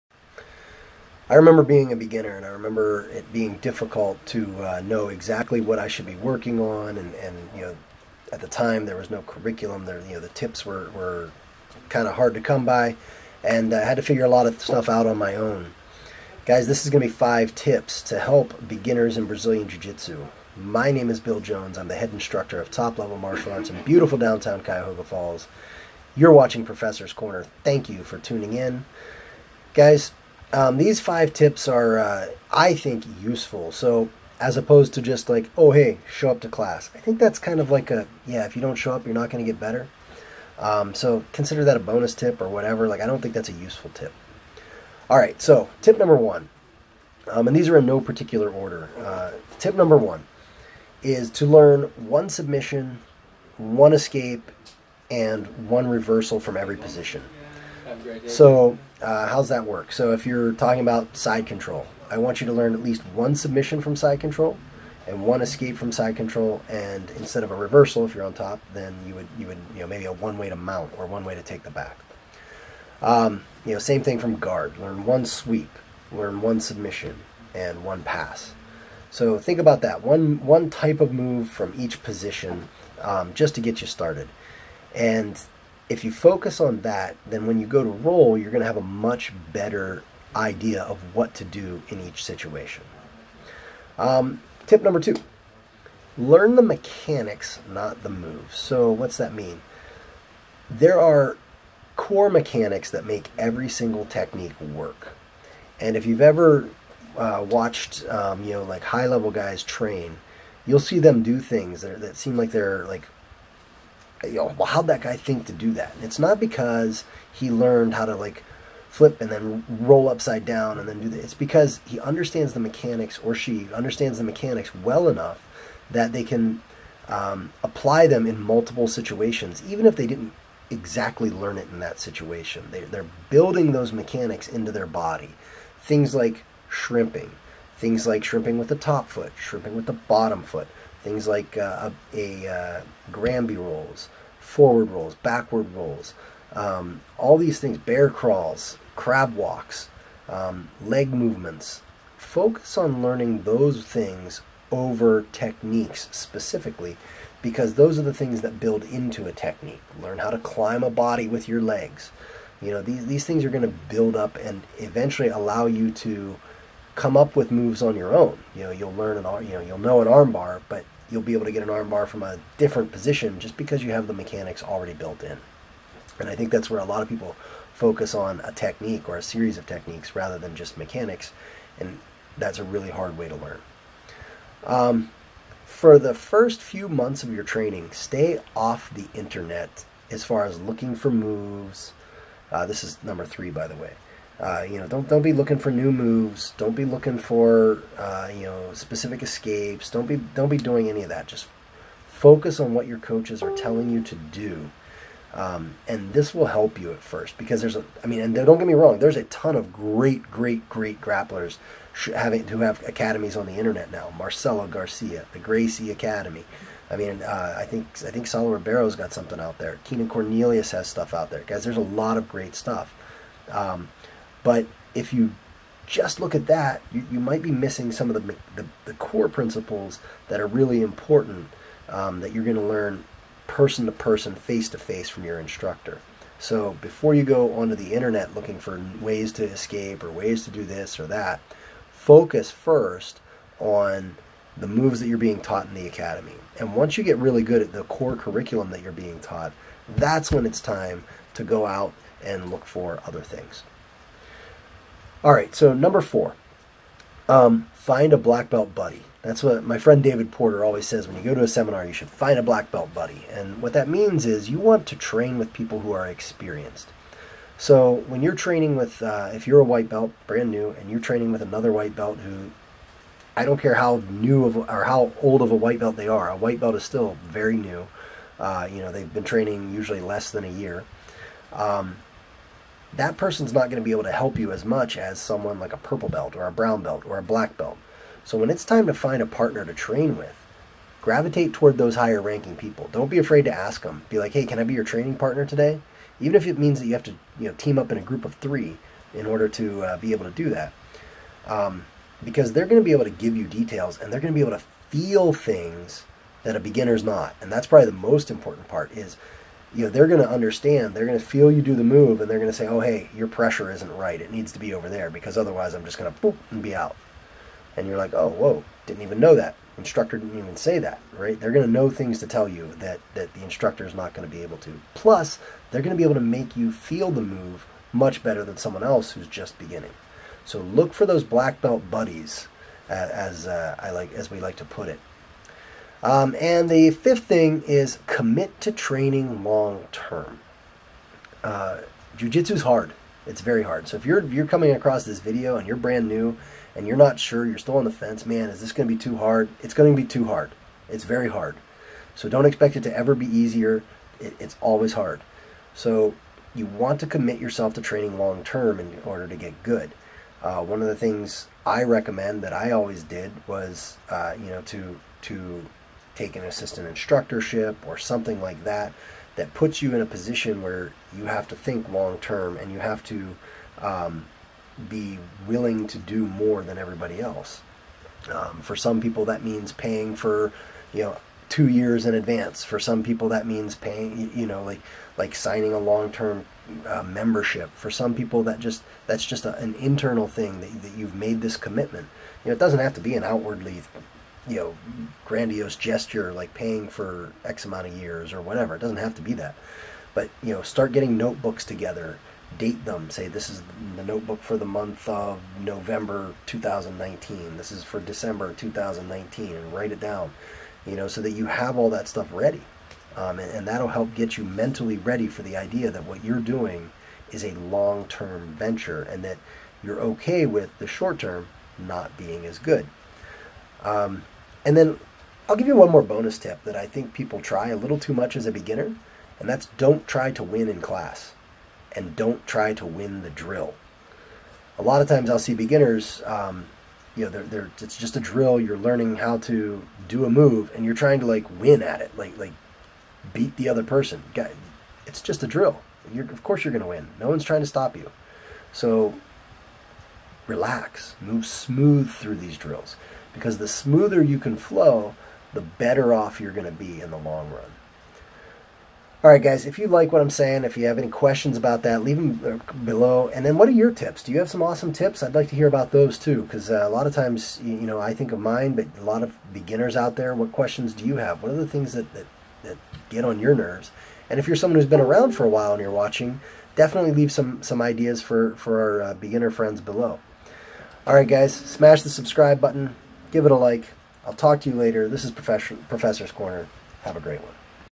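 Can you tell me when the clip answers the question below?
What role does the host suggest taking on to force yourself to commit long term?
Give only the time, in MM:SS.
06:06.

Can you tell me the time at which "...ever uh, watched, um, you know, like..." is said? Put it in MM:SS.
01:46.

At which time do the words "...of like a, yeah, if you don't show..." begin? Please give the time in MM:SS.
00:37.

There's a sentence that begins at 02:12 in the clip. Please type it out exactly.
They, they're building those mechanics into their body.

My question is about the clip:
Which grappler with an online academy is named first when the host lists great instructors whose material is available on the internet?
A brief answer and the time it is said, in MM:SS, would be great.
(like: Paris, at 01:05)
Marcelo Garcia, at 03:34.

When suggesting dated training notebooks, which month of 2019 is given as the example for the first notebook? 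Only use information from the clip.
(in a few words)
November.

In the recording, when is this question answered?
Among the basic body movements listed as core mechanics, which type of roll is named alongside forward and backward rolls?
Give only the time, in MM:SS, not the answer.
02:23.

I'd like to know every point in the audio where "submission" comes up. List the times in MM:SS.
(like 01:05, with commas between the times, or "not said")
00:52, 01:03, 01:16.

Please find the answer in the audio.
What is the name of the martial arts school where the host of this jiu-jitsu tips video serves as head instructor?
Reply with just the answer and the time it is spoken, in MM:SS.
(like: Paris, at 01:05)
Top Level Martial Arts, at 00:22.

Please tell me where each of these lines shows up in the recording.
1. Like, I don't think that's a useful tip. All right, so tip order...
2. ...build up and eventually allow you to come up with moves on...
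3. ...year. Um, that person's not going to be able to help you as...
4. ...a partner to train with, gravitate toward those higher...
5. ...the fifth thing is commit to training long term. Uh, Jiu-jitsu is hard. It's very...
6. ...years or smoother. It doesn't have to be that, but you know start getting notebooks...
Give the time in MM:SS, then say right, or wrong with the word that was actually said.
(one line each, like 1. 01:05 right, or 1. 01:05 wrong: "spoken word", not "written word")
1. 00:42 wrong: "number", not "order"
2. 02:43 right
3. 04:40 right
4. 04:49 right
5. 05:36 right
6. 06:37 wrong: "whatever", not "smoother".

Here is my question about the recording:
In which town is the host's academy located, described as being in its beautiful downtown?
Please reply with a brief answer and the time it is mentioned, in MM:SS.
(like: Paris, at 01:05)
Cuyahoga Falls, at 00:24.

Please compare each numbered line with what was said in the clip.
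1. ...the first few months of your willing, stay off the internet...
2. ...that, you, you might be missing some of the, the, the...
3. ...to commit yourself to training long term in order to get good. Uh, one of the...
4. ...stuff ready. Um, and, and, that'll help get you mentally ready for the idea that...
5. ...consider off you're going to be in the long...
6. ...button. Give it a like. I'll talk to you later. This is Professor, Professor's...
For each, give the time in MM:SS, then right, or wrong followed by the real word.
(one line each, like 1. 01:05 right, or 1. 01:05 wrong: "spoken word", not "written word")
1. 03:05 wrong: "training", not "willing"
2. 03:46 right
3. 05:57 right
4. 06:52 right
5. 07:35 wrong: "better", not "consider"
6. 08:02 right.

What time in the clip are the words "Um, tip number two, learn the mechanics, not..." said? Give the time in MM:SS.
01:33.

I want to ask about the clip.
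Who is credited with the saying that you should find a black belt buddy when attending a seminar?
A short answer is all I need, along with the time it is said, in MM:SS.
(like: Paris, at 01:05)
David Porter, at 04:20.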